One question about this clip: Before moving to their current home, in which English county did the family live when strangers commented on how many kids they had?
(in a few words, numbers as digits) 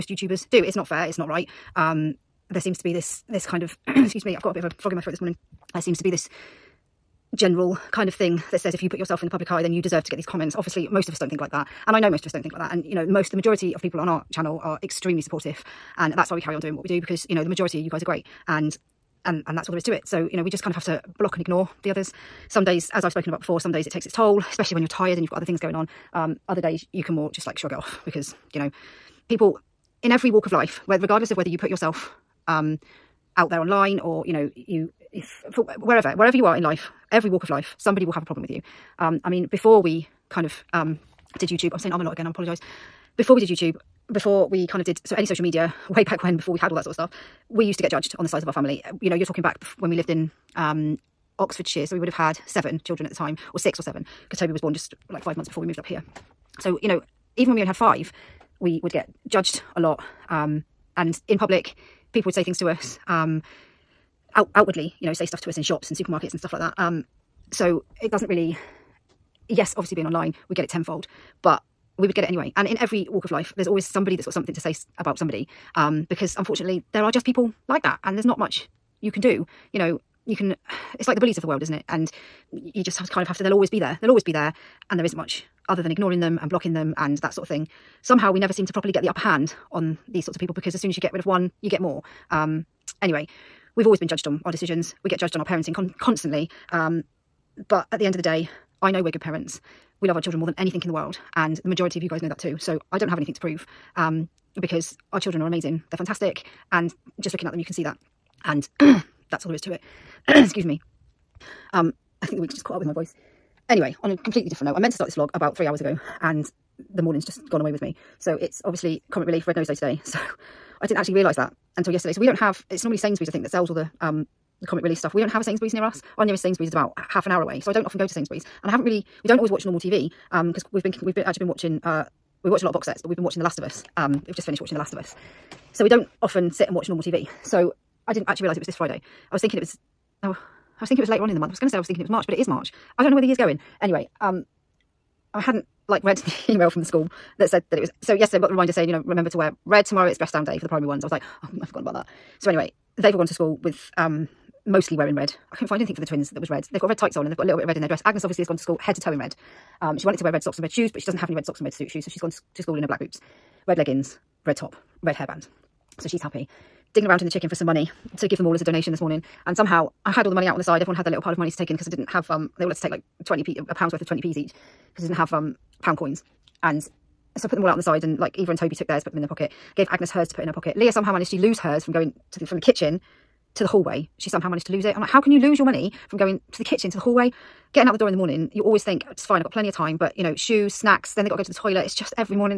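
Oxfordshire.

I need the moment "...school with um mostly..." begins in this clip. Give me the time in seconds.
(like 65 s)
153 s.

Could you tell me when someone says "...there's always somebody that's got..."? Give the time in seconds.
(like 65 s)
73 s.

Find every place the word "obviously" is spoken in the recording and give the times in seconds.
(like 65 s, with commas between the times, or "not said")
10 s, 69 s, 118 s, 158 s.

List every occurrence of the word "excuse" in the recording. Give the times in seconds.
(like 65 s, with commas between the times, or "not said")
3 s, 110 s.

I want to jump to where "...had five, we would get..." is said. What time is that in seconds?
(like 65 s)
57 s.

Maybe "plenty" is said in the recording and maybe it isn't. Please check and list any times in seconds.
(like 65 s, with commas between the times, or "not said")
189 s.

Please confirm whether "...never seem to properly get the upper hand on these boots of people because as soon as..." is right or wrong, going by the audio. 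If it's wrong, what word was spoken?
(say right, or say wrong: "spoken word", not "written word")
wrong: "sorts", not "boots".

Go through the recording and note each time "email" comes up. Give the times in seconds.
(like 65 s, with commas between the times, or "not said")
146 s.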